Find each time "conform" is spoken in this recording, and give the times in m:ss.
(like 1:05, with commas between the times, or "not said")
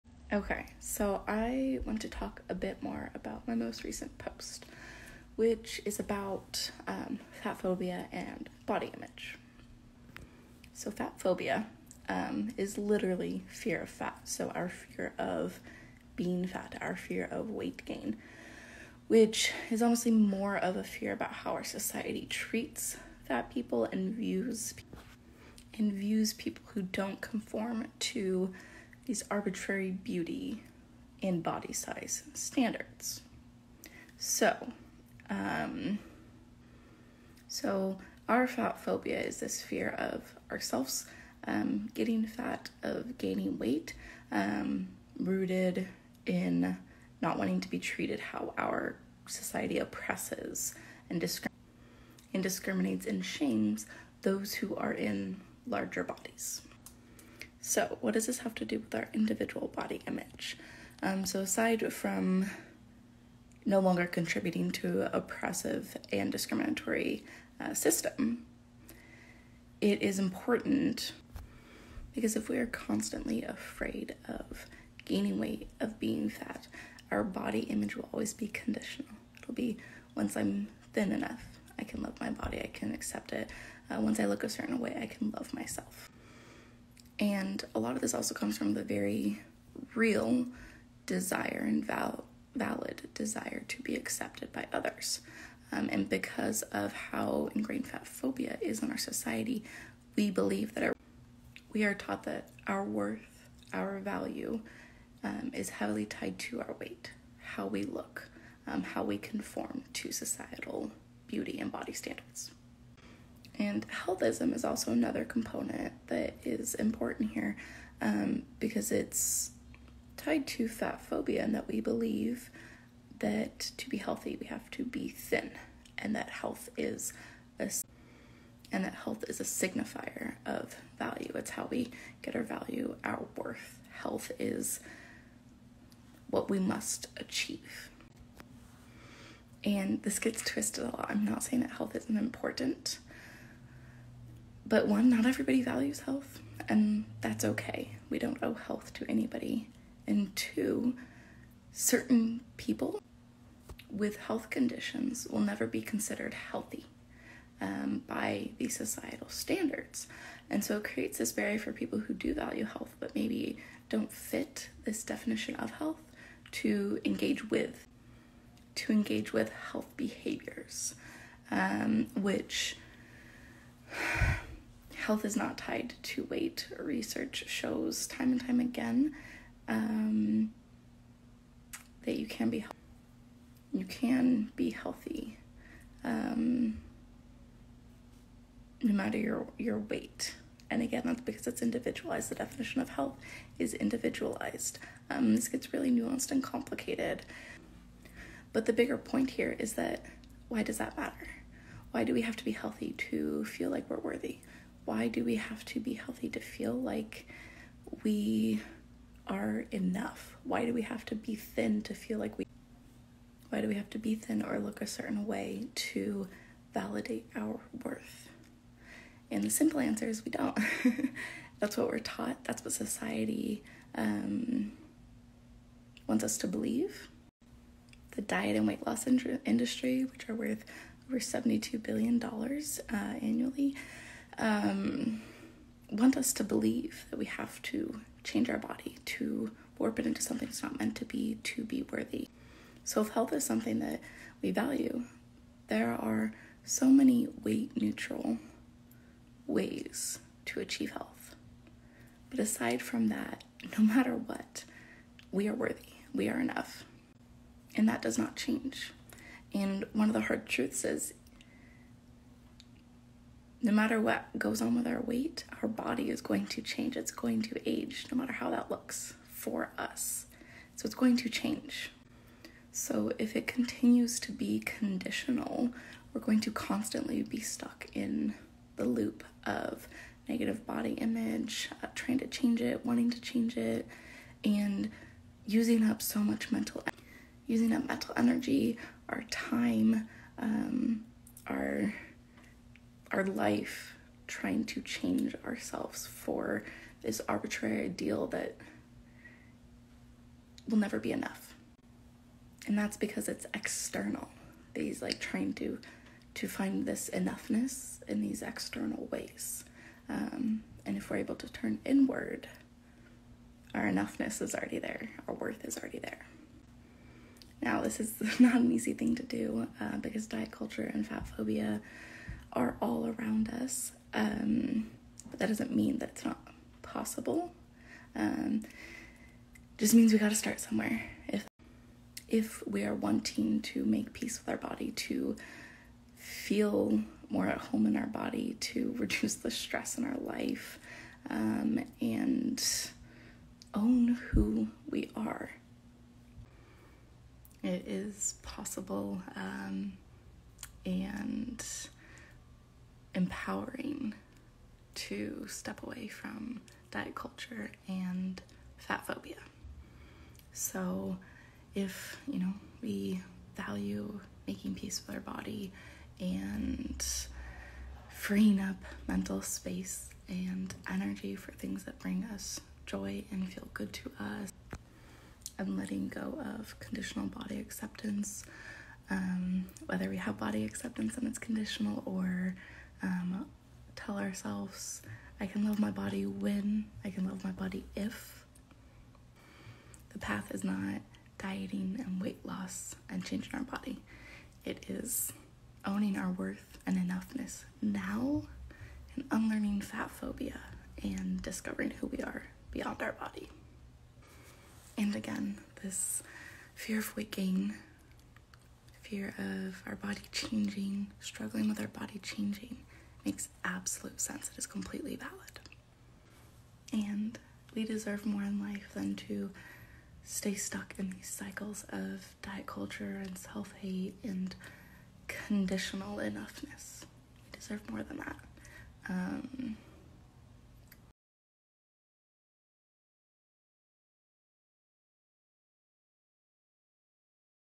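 0:27, 1:49.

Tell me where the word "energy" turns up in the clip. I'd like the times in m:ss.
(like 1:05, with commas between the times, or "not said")
4:48, 6:10.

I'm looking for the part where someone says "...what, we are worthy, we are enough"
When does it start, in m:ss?
4:14.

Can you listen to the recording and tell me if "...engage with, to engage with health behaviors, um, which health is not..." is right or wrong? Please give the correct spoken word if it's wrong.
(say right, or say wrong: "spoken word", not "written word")
right.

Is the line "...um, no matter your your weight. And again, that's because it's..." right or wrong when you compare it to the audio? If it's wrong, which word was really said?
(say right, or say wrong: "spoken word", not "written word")
right.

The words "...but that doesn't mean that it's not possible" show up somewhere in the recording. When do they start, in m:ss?
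5:25.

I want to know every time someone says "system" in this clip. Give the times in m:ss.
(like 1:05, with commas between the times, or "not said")
1:07.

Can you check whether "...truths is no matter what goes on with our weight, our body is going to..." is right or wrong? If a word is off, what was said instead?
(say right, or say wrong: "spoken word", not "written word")
right.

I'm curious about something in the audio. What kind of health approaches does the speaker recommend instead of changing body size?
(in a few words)
Weight neutral ways.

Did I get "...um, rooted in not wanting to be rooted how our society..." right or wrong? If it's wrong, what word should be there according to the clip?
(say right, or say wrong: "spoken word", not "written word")
wrong: "treated", not "rooted".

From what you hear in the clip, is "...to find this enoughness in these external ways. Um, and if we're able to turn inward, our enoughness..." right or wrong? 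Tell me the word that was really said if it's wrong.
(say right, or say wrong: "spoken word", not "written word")
right.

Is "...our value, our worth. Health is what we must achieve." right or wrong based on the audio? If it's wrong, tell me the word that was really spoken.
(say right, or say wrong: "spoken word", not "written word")
right.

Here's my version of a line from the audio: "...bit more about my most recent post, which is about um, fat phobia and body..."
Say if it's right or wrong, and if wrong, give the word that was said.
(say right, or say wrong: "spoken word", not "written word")
right.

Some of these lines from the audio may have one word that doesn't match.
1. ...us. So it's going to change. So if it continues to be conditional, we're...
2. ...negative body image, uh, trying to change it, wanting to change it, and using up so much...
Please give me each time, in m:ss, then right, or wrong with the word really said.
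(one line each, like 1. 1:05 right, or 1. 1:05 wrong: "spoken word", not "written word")
1. 4:29 right
2. 4:40 right.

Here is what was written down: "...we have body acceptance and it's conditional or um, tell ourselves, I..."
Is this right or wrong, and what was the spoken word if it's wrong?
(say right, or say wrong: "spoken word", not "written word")
right.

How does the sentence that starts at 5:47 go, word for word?
It is possible, um, and empowering to step away from diet culture and fat phobia.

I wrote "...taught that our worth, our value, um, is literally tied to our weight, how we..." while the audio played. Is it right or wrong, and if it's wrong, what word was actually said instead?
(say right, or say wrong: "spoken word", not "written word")
wrong: "heavily", not "literally".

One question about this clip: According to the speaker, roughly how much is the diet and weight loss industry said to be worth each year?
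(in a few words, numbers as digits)
Over $72 billion.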